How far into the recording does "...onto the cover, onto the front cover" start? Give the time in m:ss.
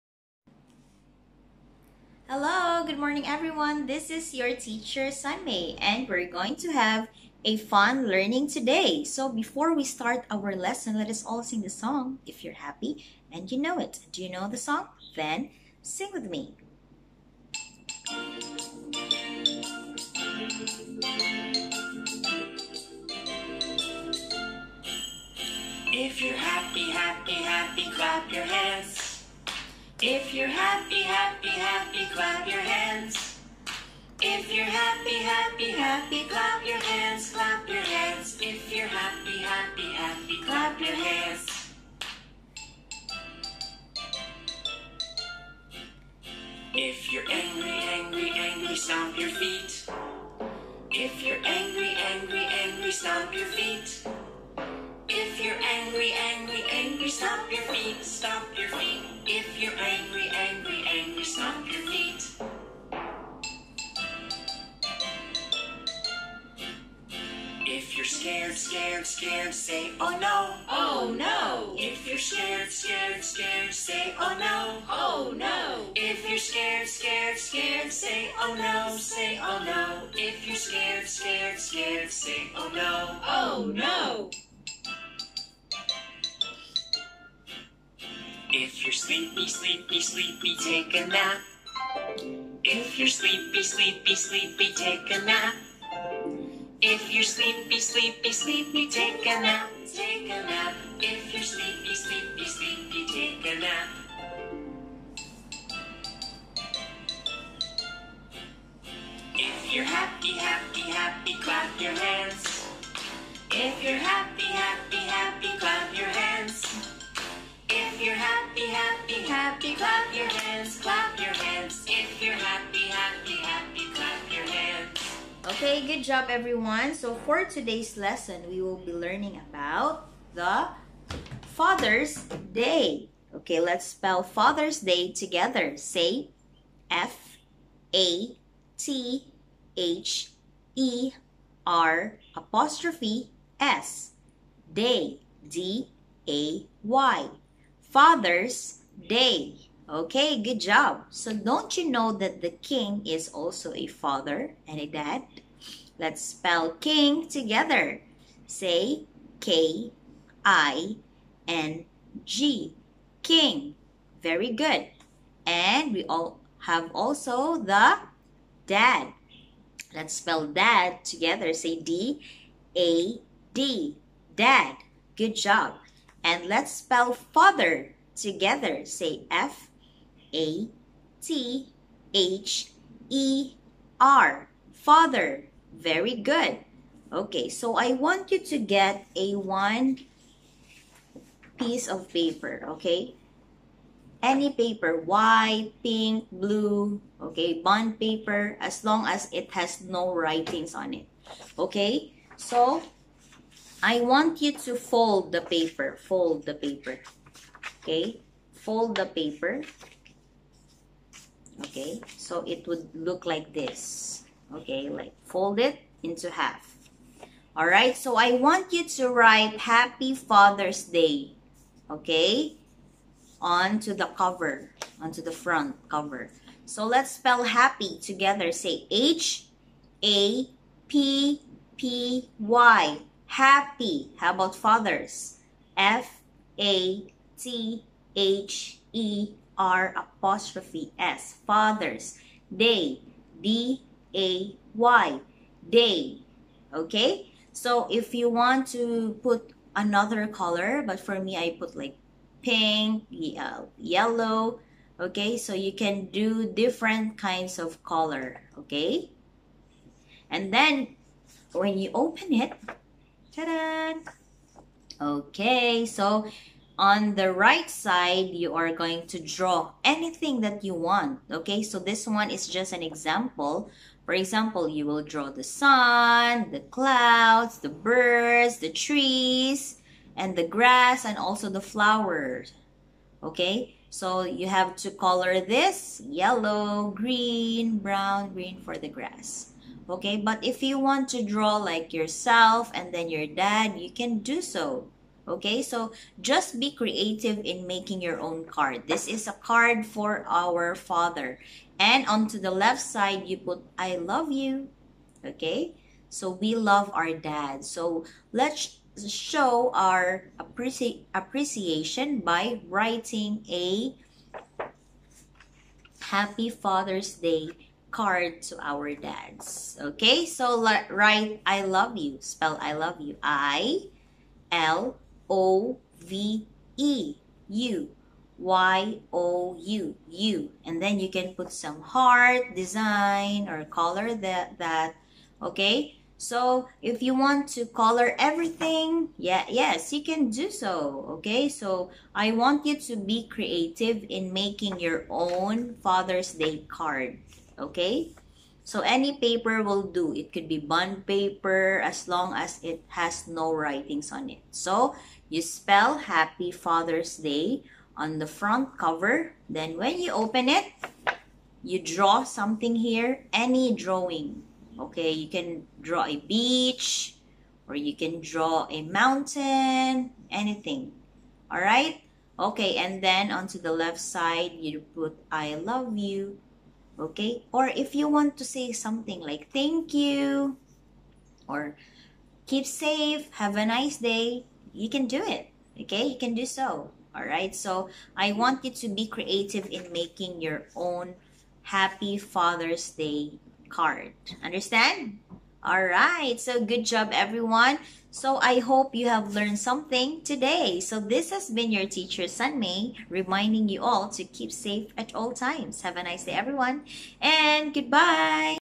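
3:43.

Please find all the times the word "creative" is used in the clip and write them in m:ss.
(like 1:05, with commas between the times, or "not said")
4:56, 5:43, 6:29.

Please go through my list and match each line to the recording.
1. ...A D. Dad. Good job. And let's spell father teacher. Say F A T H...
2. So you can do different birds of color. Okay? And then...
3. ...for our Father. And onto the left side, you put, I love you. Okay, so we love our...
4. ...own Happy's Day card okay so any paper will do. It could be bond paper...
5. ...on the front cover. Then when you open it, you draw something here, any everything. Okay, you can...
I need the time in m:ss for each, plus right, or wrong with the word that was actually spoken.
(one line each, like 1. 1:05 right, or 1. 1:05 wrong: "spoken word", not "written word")
1. 2:52 wrong: "together", not "teacher"
2. 4:15 wrong: "kinds", not "birds"
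3. 4:59 right
4. 5:45 wrong: "Father", not "Happy"
5. 5:57 wrong: "drawing", not "everything".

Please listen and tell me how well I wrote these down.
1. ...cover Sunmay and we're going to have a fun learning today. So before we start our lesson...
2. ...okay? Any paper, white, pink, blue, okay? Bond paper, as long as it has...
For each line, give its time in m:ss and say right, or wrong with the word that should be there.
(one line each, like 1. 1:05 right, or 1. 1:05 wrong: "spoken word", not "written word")
1. 0:04 wrong: "teacher", not "cover"
2. 3:12 right.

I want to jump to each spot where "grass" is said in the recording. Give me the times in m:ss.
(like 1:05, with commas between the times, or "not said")
4:40, 4:48.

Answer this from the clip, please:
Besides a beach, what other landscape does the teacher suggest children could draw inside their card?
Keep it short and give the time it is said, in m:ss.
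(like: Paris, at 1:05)
A mountain, at 6:08.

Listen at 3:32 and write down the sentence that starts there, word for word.
So, it would look like this, Okay, like fold it into half.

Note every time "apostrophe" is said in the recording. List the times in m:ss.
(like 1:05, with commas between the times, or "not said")
2:22, 3:59.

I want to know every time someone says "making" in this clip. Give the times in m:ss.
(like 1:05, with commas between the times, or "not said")
4:57, 5:44, 6:29.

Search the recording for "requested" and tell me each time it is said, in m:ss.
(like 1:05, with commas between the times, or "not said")
not said.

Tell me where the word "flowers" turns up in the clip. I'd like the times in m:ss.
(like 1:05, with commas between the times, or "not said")
4:41.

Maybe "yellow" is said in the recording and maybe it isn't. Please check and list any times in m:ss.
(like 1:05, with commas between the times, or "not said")
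4:13, 4:46.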